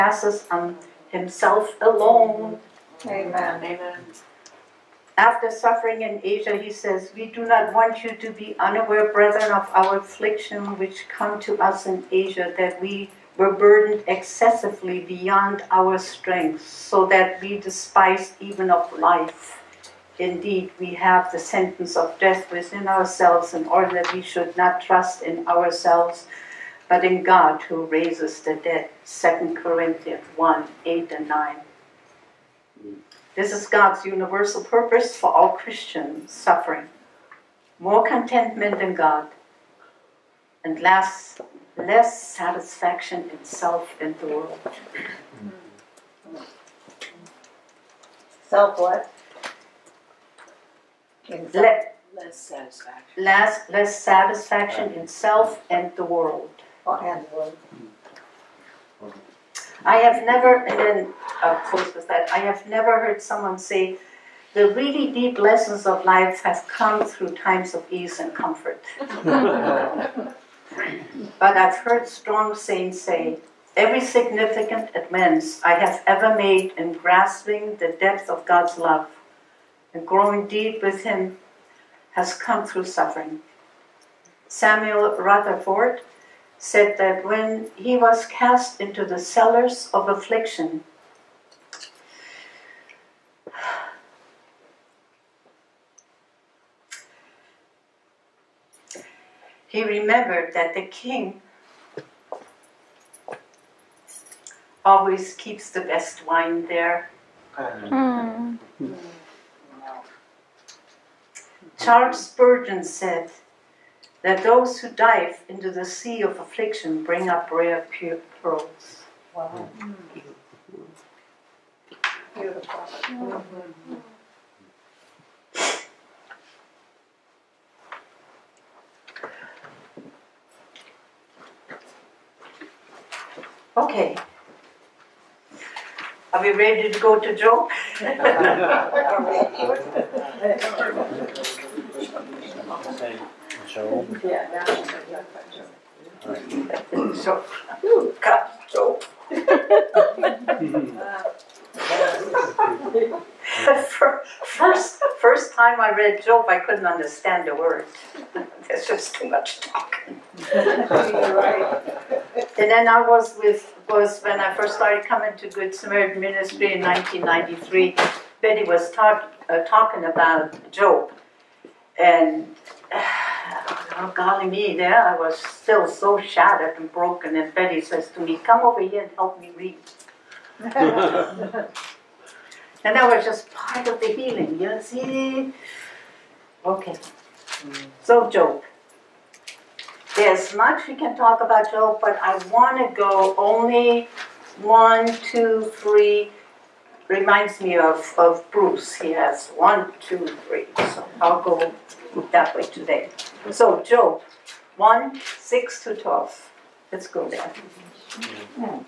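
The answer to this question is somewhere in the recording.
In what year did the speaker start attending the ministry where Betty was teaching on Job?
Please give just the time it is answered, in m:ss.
2:46.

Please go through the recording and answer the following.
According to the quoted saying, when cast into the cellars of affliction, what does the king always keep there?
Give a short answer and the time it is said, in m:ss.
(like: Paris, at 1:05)
The best wine, at 1:45.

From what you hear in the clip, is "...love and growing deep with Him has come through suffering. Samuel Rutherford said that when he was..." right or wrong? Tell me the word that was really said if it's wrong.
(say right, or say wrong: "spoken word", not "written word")
right.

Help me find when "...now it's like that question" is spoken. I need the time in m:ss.
2:24.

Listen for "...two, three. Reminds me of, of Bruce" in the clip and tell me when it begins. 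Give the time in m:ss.
3:15.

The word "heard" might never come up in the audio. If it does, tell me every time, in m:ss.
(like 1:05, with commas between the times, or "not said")
1:02, 1:11.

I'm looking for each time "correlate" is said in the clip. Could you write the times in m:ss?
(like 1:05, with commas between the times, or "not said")
not said.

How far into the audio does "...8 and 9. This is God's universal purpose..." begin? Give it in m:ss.
0:30.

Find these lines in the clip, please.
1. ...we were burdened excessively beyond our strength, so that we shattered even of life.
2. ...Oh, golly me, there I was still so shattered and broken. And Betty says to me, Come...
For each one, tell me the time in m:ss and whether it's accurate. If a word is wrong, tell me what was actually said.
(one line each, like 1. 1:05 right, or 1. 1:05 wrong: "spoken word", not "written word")
1. 0:12 wrong: "despised", not "shattered"
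2. 2:53 right.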